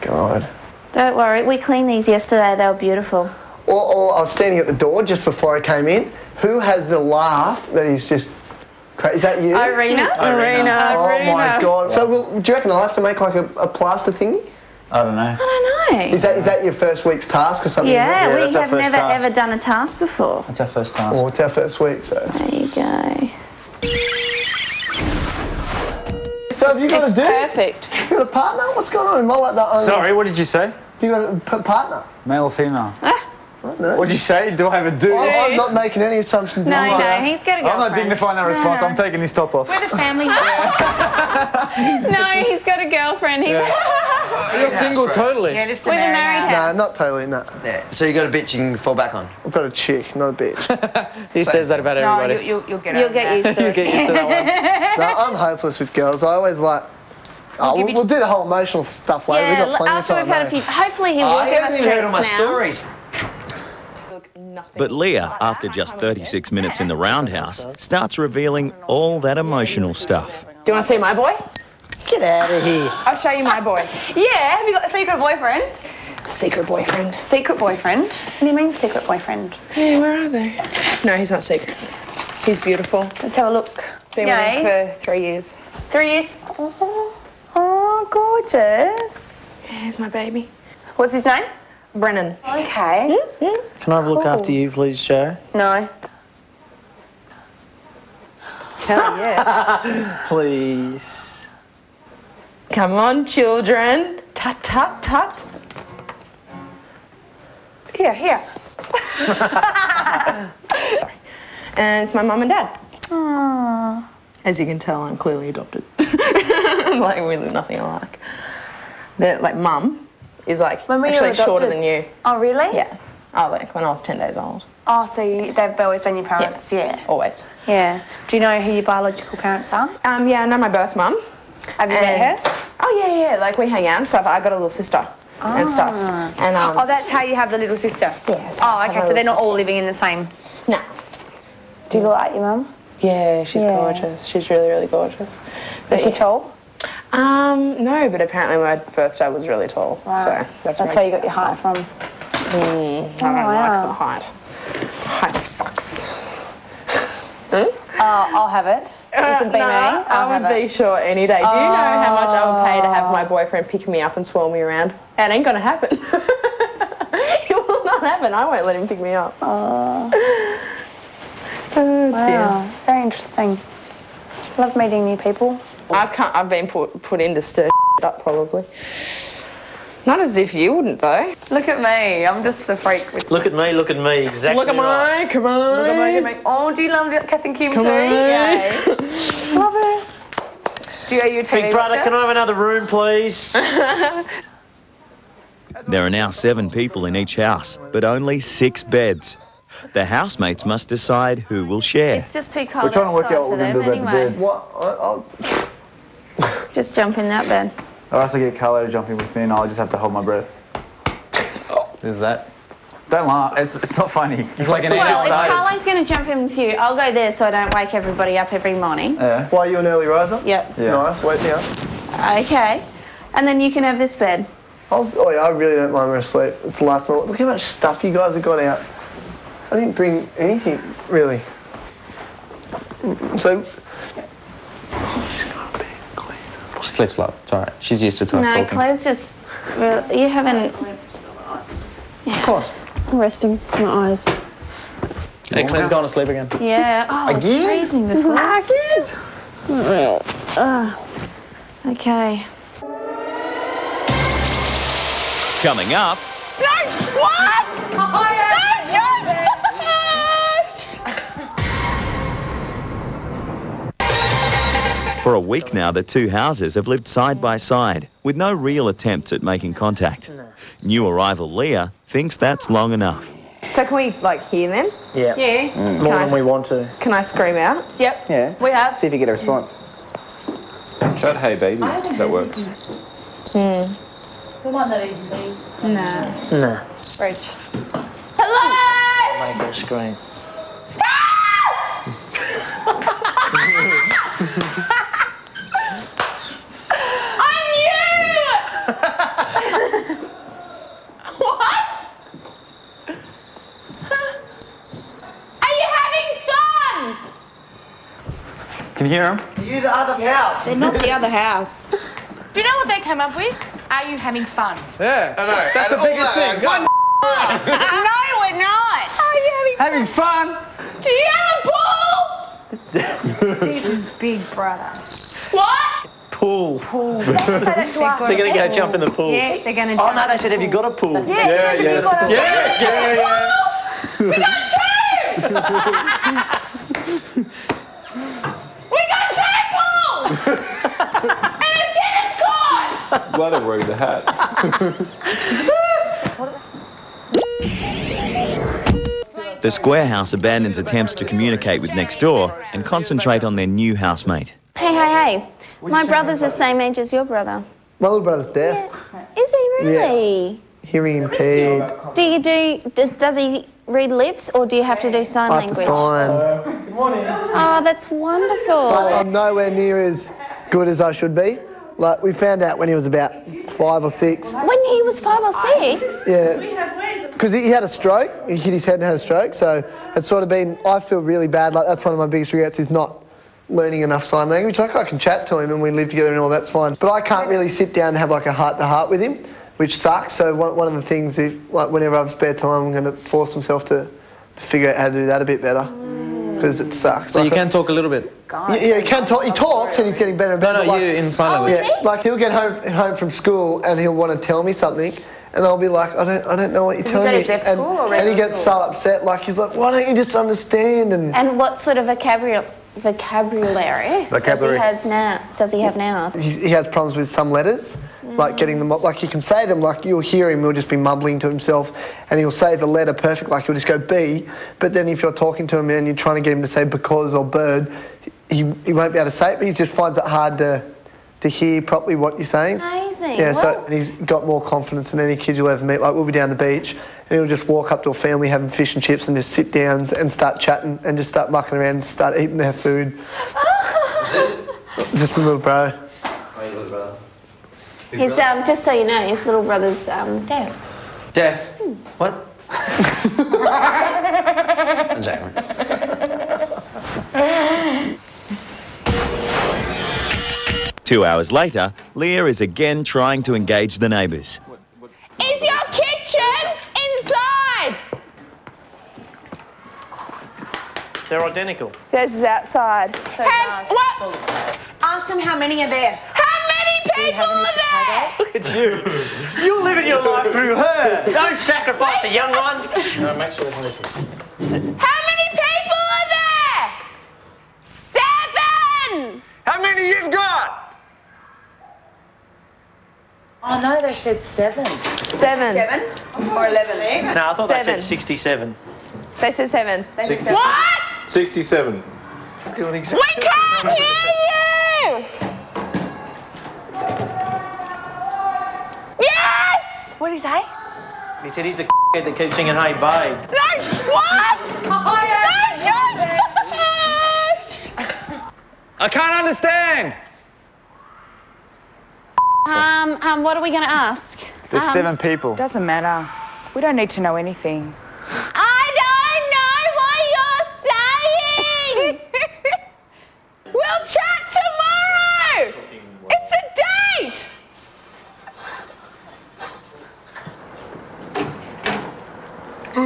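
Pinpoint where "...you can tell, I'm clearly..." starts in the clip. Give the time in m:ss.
1:54.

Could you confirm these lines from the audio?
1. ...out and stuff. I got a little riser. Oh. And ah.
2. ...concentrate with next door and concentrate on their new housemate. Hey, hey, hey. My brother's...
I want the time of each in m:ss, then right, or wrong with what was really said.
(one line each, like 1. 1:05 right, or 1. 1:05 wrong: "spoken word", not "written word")
1. 2:13 wrong: "sister", not "riser"
2. 5:51 wrong: "communicate", not "concentrate".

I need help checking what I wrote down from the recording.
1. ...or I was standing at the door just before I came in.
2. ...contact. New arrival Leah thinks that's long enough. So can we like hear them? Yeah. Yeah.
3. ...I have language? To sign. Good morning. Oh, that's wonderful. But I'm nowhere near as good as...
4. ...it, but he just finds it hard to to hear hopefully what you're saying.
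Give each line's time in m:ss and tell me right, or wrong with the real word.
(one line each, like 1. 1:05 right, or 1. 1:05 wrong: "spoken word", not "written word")
1. 0:03 right
2. 4:29 right
3. 6:05 right
4. 7:09 wrong: "properly", not "hopefully".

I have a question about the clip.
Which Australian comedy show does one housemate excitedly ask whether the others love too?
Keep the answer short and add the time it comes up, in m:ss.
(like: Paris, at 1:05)
Kath and Kim, at 3:07.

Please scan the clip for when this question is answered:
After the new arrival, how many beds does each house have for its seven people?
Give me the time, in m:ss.
3:18.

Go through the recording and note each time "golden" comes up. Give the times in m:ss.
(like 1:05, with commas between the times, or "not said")
not said.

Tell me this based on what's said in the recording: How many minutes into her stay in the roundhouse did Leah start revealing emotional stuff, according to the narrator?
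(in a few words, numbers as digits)
36.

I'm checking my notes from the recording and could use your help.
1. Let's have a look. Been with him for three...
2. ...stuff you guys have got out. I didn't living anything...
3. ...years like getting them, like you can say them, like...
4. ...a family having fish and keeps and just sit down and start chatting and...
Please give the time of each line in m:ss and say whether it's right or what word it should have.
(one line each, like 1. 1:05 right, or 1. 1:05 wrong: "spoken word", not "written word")
1. 1:23 right
2. 3:47 wrong: "bring", not "living"
3. 6:57 wrong: "letters", not "years"
4. 7:18 wrong: "chips", not "keeps".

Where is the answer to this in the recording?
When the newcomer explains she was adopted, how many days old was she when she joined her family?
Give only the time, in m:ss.
2:04.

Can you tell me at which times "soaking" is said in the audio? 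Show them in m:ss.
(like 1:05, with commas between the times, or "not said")
not said.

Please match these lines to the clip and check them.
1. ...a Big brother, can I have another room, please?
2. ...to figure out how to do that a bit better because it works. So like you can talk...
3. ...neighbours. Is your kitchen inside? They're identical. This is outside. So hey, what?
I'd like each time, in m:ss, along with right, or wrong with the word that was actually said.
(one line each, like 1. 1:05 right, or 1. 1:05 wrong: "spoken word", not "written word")
1. 3:11 right
2. 6:34 wrong: "sucks", not "works"
3. 7:44 right.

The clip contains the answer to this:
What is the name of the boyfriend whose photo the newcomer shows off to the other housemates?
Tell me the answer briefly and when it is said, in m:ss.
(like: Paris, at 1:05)
Brennan, at 1:31.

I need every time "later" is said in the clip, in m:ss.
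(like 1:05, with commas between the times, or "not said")
0:59, 7:41.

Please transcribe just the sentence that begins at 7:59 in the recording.
You're living your life through her.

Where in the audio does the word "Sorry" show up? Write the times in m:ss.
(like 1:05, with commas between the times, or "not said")
0:29.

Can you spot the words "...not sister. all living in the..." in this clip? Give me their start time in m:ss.
2:19.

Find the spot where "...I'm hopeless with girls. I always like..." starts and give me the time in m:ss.
0:55.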